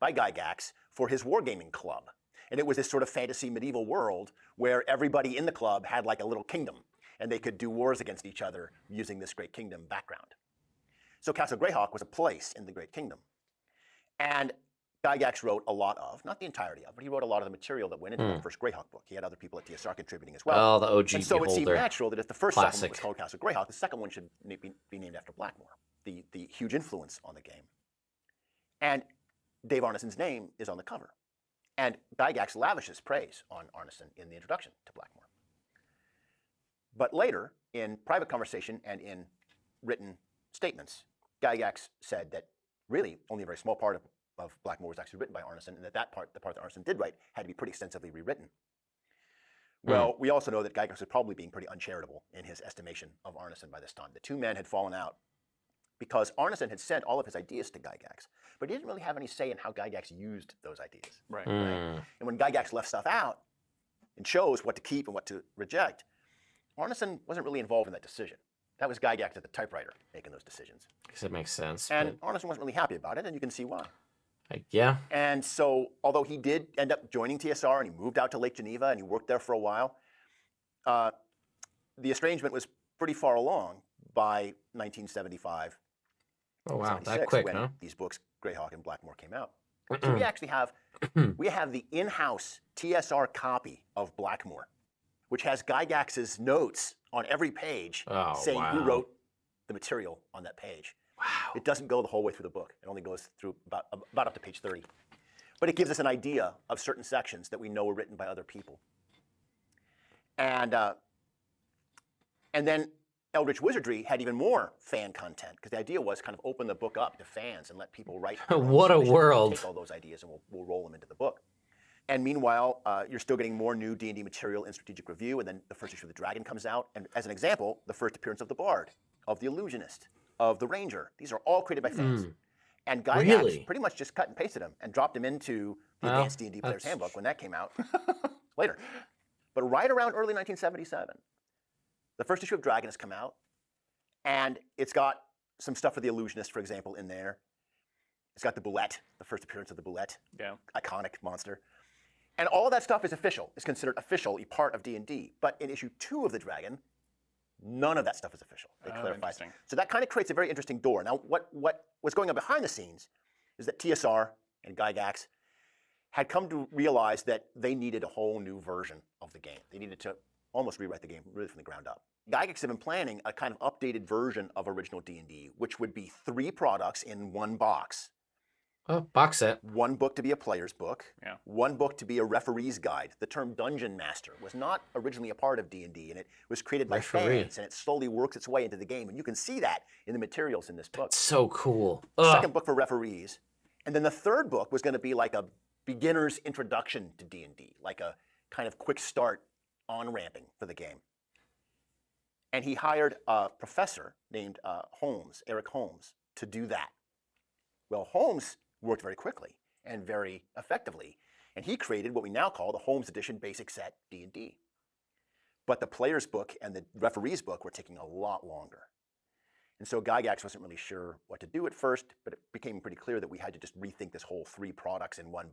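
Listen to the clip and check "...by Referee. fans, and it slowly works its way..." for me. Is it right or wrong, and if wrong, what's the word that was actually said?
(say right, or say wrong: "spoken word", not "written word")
right.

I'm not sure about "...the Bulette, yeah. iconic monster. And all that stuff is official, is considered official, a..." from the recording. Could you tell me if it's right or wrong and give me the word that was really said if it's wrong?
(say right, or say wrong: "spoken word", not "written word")
right.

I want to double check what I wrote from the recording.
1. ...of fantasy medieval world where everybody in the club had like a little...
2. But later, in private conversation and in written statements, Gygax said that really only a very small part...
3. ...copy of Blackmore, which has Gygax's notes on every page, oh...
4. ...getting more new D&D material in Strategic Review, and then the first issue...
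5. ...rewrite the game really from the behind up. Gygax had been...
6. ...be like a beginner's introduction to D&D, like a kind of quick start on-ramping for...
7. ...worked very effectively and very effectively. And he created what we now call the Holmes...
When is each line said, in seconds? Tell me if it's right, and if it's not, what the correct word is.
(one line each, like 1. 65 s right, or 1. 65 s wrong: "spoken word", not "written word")
1. 3 s right
2. 36 s right
3. 93 s right
4. 123 s right
5. 170 s wrong: "ground", not "behind"
6. 194 s right
7. 208 s wrong: "quickly", not "effectively".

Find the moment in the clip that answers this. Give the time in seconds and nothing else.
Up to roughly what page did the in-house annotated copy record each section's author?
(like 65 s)
104 s.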